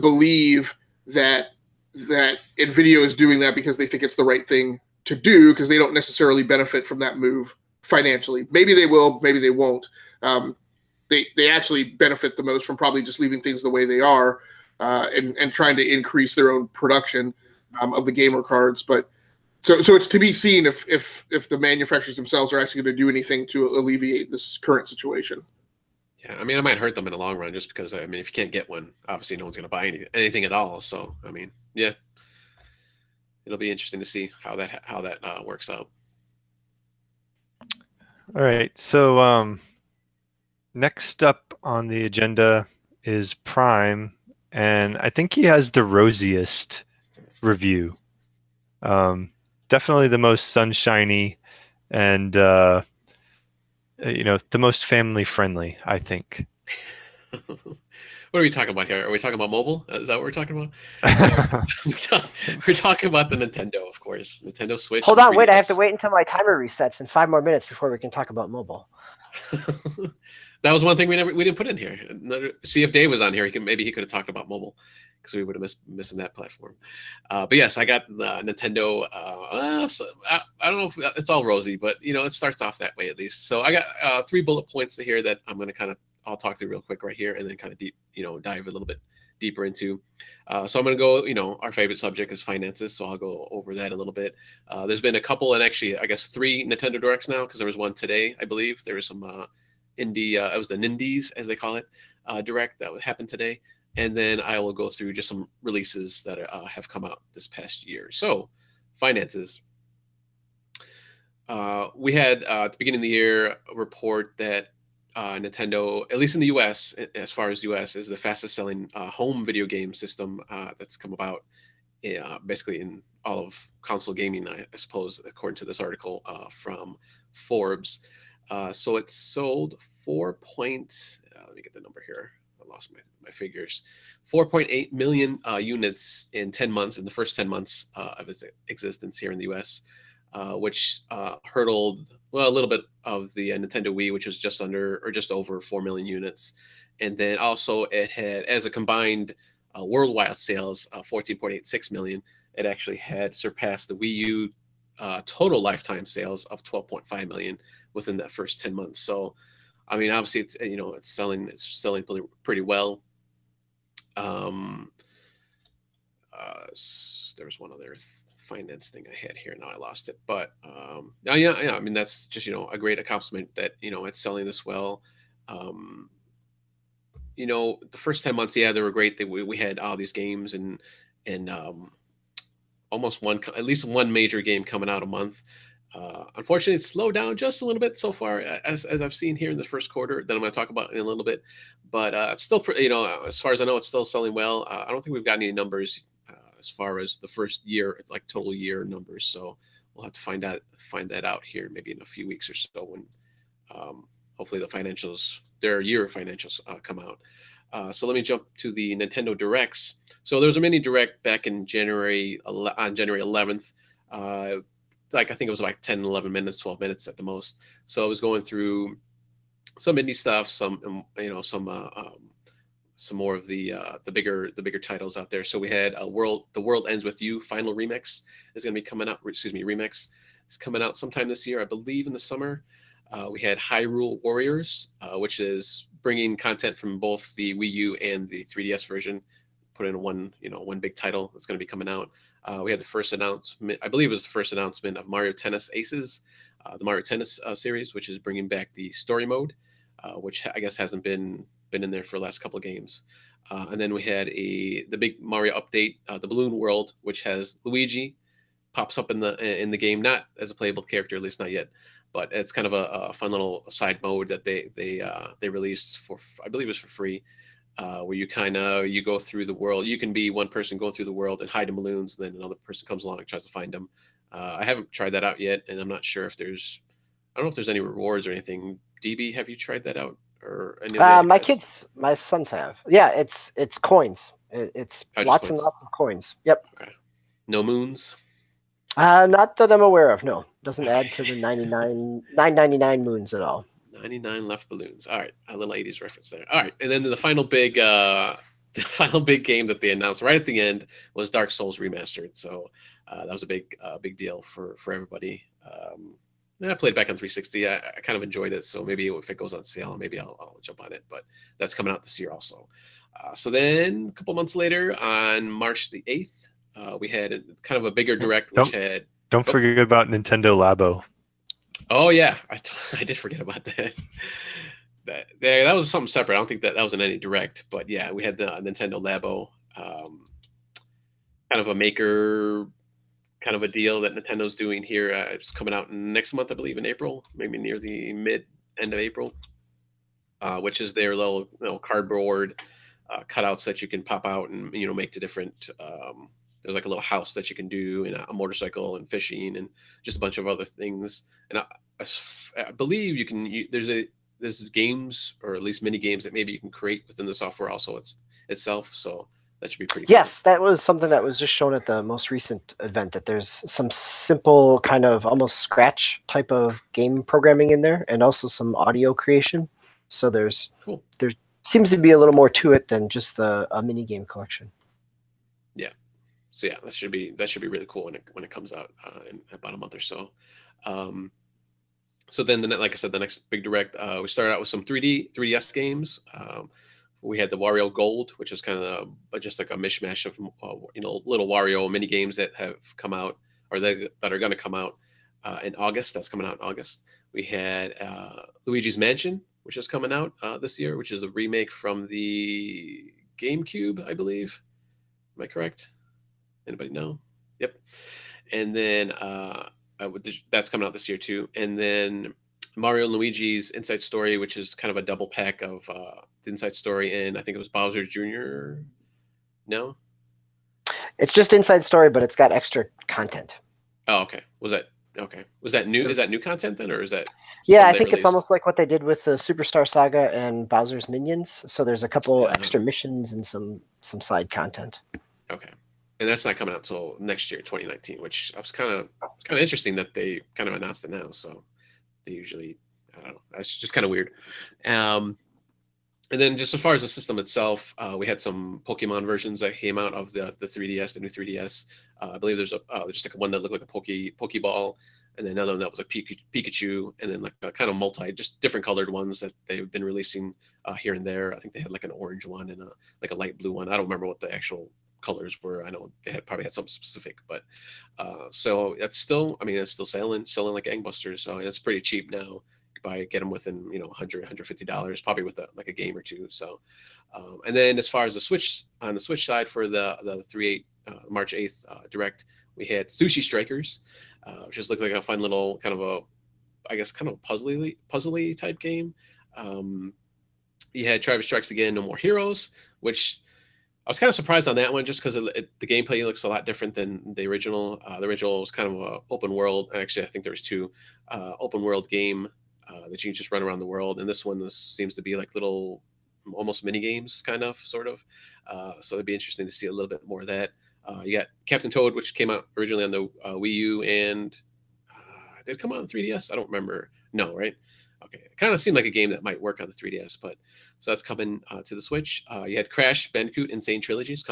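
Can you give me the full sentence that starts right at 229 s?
Excuse me, remix is coming out sometime this year, I believe, in the summer.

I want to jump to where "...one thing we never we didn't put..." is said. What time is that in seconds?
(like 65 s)
70 s.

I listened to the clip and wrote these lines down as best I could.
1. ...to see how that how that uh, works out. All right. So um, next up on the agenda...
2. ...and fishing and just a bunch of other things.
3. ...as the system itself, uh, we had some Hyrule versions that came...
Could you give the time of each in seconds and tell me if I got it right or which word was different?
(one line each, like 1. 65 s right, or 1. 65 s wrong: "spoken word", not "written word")
1. 33 s right
2. 348 s right
3. 446 s wrong: "Pokemon", not "Hyrule".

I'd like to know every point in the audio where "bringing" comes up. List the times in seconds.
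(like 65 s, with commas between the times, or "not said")
236 s, 248 s.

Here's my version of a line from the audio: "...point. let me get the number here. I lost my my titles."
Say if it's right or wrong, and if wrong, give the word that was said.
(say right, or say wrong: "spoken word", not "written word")
wrong: "figures", not "titles".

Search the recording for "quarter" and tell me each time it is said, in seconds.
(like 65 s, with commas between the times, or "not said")
189 s.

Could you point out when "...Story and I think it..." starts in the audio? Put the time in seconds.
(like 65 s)
416 s.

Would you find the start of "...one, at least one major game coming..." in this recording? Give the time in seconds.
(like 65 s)
183 s.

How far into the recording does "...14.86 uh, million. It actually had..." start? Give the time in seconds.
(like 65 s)
150 s.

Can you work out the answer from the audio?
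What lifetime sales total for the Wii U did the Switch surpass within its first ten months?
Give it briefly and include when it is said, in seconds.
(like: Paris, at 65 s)
12.5 million, at 156 s.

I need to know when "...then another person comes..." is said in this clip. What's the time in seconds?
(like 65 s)
272 s.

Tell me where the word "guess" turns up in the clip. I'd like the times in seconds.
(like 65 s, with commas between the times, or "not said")
96 s, 250 s, 486 s.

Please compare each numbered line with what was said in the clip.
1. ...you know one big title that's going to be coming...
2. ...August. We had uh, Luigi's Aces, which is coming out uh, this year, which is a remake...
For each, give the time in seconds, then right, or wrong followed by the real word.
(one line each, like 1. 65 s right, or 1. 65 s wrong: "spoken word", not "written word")
1. 240 s right
2. 396 s wrong: "Mansion", not "Aces".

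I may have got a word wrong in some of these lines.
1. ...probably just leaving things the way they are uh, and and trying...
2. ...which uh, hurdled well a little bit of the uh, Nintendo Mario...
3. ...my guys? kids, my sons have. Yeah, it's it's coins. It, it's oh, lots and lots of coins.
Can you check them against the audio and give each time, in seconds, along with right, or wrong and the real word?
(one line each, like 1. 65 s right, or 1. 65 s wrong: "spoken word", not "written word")
1. 12 s right
2. 140 s wrong: "Wii", not "Mario"
3. 281 s right.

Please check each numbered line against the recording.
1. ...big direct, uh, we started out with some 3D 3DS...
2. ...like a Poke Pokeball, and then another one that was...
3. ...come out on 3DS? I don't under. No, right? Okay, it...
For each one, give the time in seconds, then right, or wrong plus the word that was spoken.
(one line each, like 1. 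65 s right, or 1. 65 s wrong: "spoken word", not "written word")
1. 383 s right
2. 453 s right
3. 515 s wrong: "remember", not "under".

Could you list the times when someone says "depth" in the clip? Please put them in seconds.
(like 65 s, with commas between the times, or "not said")
not said.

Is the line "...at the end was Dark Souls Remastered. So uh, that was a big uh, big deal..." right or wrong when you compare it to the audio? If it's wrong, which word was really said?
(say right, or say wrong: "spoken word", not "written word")
right.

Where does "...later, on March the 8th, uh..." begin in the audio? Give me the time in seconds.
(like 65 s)
314 s.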